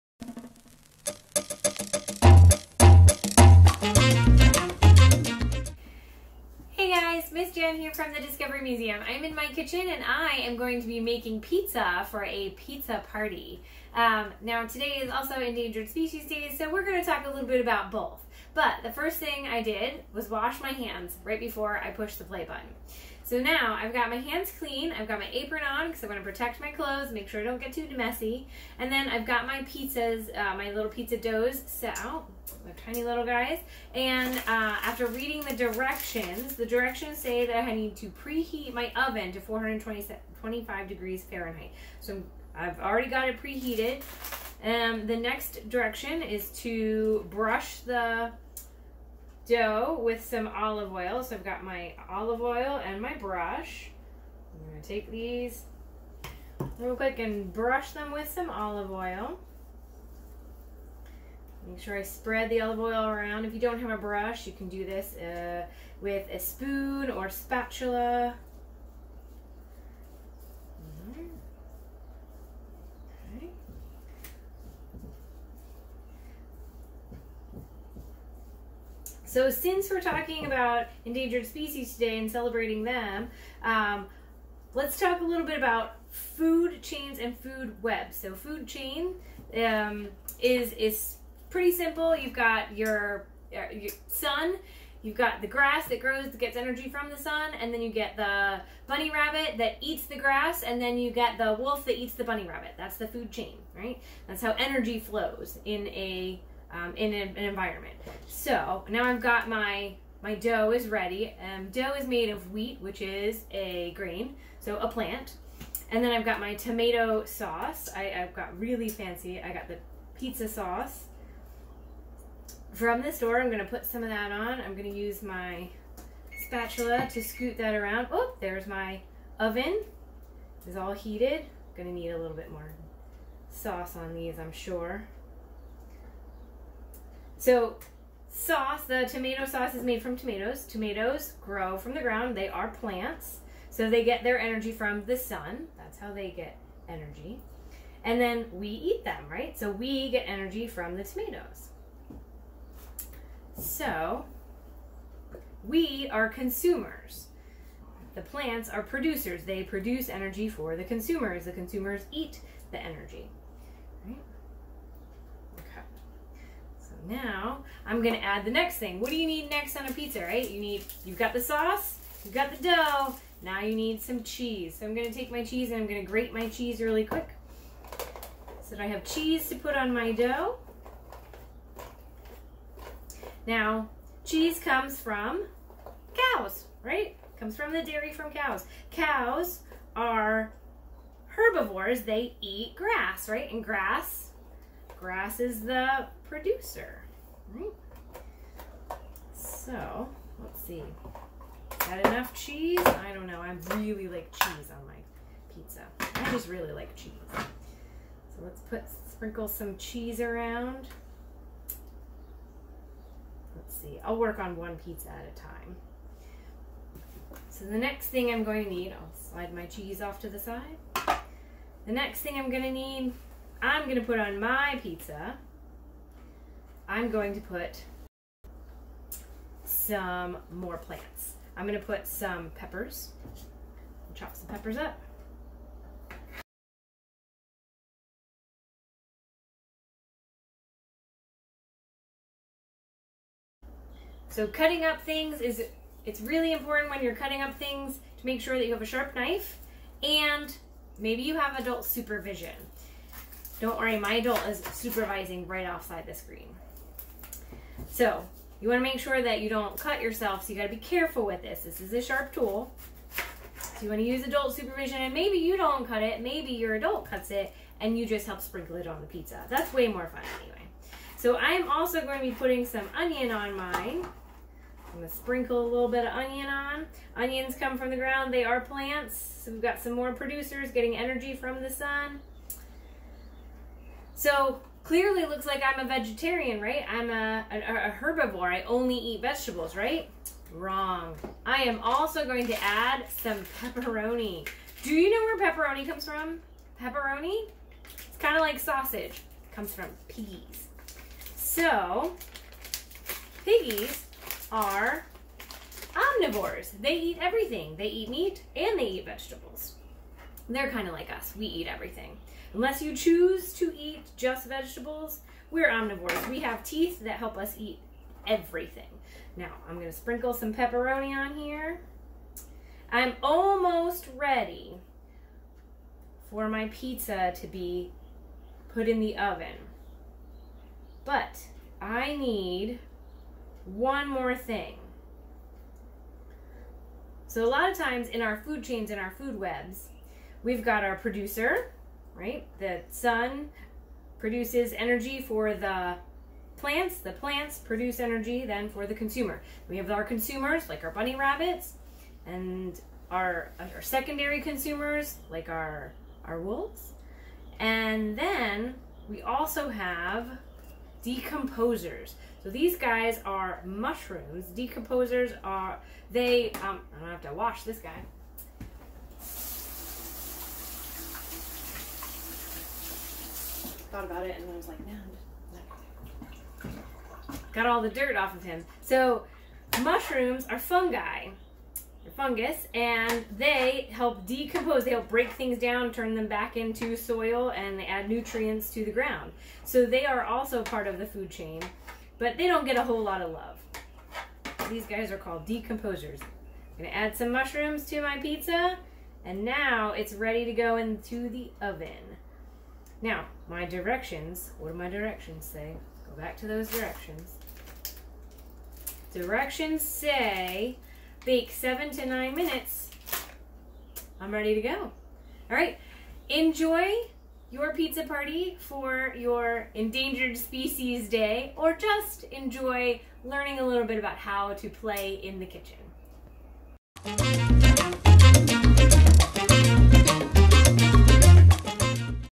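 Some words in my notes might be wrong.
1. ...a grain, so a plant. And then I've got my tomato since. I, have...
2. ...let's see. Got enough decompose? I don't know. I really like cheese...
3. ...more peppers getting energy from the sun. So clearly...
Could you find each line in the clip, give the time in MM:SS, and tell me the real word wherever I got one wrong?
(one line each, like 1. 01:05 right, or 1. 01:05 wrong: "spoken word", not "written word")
1. 01:53 wrong: "sauce", not "since"
2. 03:20 wrong: "cheese", not "decompose"
3. 04:39 wrong: "producers", not "peppers".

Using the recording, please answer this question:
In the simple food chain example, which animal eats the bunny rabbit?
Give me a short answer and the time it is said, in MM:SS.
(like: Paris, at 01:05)
wolf, at 01:41.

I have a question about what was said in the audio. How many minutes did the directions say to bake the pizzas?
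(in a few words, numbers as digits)
7 to 9 minutes.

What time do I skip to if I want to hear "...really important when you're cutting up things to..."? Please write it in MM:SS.
04:06.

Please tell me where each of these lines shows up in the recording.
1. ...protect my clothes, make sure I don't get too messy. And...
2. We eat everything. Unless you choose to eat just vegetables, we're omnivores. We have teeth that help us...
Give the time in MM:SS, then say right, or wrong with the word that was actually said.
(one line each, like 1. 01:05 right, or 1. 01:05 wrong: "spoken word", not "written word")
1. 00:26 right
2. 05:11 right.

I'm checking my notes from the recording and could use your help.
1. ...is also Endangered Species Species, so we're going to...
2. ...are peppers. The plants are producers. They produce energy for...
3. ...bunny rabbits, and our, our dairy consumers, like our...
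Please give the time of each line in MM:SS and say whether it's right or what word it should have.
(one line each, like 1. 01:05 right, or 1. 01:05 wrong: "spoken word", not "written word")
1. 00:15 wrong: "Day", not "Species"
2. 02:36 wrong: "consumers", not "peppers"
3. 05:50 wrong: "secondary", not "dairy".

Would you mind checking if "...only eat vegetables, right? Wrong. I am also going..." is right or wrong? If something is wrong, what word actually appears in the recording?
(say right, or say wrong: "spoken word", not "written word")
right.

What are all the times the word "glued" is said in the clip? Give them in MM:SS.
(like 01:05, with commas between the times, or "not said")
not said.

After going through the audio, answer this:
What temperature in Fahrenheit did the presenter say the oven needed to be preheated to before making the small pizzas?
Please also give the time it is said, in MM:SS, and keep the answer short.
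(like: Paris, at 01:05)
425 degrees, at 00:39.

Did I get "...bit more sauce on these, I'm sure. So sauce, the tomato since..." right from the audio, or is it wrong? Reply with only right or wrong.
wrong.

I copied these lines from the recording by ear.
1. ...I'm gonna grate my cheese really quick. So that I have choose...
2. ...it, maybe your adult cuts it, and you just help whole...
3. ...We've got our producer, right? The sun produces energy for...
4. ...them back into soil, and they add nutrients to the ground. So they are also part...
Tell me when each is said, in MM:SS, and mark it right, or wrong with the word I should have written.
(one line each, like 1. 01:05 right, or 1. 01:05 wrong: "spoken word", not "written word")
1. 02:55 wrong: "cheese", not "choose"
2. 04:26 wrong: "sprinkle", not "whole"
3. 05:40 right
4. 06:26 right.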